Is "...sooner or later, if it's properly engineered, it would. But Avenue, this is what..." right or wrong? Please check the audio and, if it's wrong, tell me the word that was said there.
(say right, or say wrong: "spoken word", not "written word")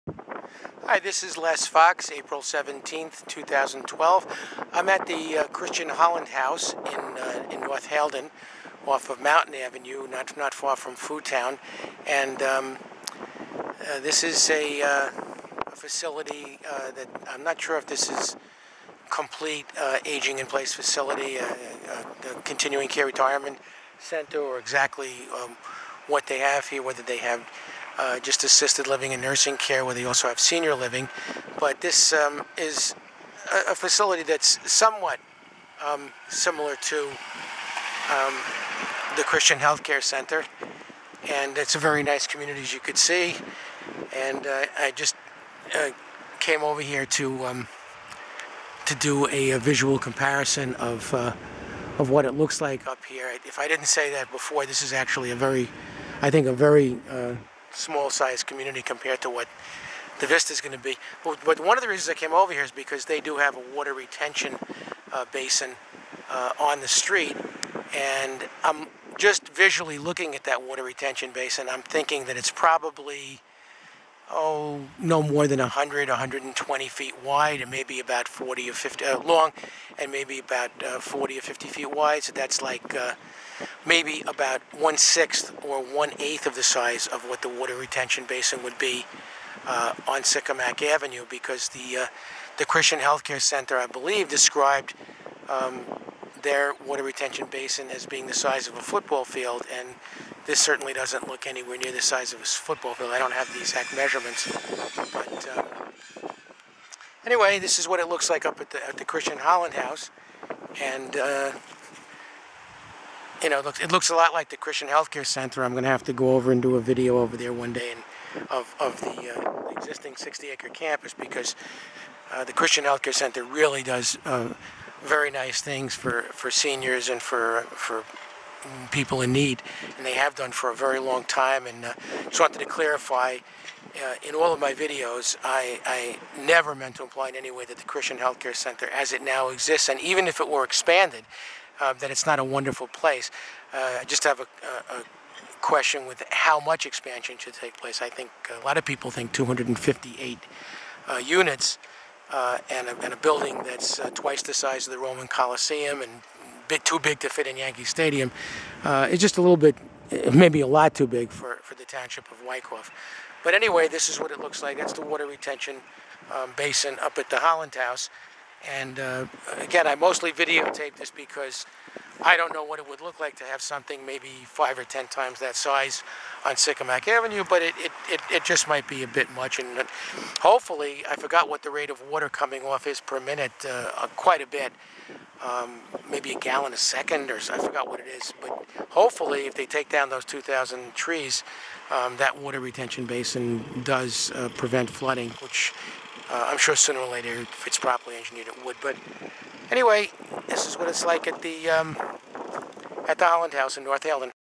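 wrong: "Anyway", not "Avenue".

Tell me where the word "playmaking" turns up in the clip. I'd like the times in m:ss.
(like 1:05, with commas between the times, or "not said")
not said.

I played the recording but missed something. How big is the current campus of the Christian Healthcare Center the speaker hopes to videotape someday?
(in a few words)
60-acre.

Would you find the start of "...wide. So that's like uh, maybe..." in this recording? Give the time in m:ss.
1:21.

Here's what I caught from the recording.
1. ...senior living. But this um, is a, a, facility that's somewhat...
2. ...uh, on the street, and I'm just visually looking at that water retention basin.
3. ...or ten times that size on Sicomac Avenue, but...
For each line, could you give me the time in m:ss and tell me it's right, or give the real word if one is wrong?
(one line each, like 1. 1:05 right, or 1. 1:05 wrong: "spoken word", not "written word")
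1. 0:30 right
2. 1:06 right
3. 2:54 right.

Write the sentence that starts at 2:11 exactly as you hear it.
And uh, just wanted to clarify.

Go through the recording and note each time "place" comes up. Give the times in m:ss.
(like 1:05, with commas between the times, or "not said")
0:20, 2:22, 2:27.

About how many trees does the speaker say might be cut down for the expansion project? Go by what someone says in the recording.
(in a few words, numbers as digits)
2,000.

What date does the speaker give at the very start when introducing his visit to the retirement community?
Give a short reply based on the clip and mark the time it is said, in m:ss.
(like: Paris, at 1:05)
April 17th, 2012, at 0:02.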